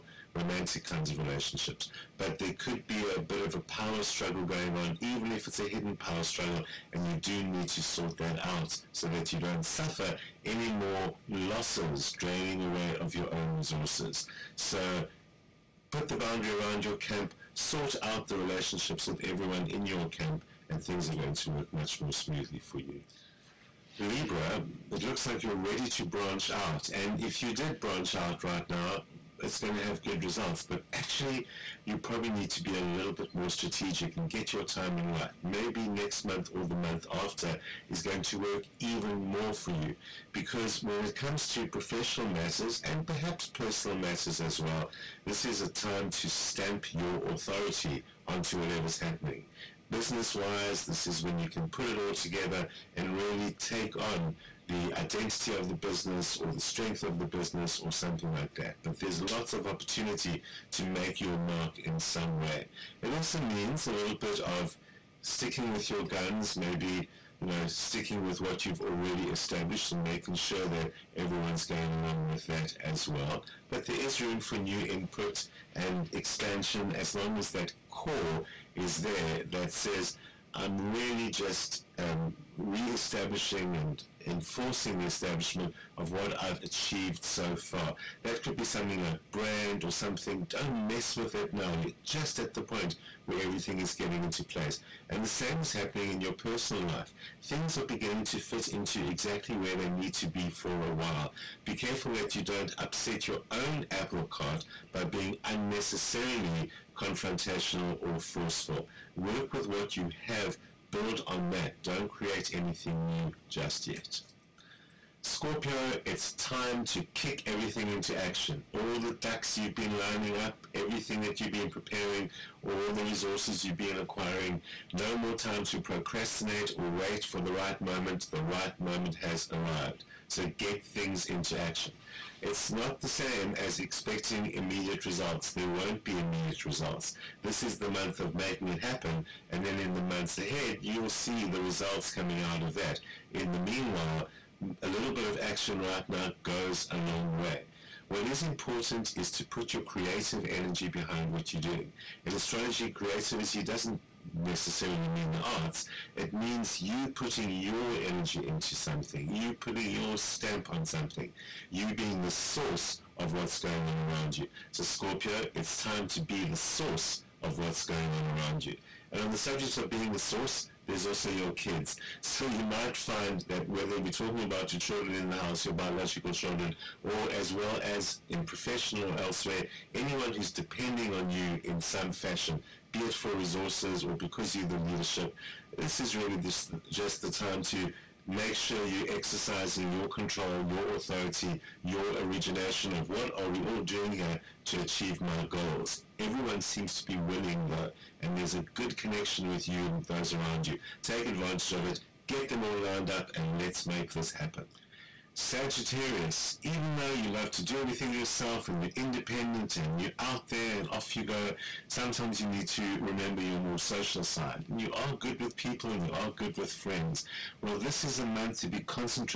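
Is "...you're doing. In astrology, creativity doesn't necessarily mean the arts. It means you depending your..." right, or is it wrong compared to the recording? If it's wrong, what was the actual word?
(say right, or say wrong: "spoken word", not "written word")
wrong: "putting", not "depending".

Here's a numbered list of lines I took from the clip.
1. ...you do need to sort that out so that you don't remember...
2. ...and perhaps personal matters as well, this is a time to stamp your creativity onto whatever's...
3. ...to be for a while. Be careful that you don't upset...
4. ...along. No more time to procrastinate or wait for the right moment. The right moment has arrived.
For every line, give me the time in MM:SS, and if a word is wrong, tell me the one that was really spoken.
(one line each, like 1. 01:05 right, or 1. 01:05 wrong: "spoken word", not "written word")
1. 00:07 wrong: "suffer", not "remember"
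2. 00:42 wrong: "authority", not "creativity"
3. 01:40 right
4. 02:03 wrong: "acquiring", not "along".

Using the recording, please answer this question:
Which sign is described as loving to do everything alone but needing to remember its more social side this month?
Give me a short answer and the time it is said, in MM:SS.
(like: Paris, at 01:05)
Sagittarius, at 03:25.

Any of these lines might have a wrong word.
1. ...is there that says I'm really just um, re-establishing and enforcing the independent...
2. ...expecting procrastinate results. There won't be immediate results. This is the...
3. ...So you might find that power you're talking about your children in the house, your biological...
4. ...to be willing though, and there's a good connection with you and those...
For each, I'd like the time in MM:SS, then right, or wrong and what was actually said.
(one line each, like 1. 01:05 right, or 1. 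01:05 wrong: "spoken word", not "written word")
1. 01:18 wrong: "establishment", not "independent"
2. 02:13 wrong: "immediate", not "procrastinate"
3. 02:52 wrong: "whether", not "power"
4. 03:16 right.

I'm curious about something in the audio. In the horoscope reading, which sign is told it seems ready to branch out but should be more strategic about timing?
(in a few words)
Libra.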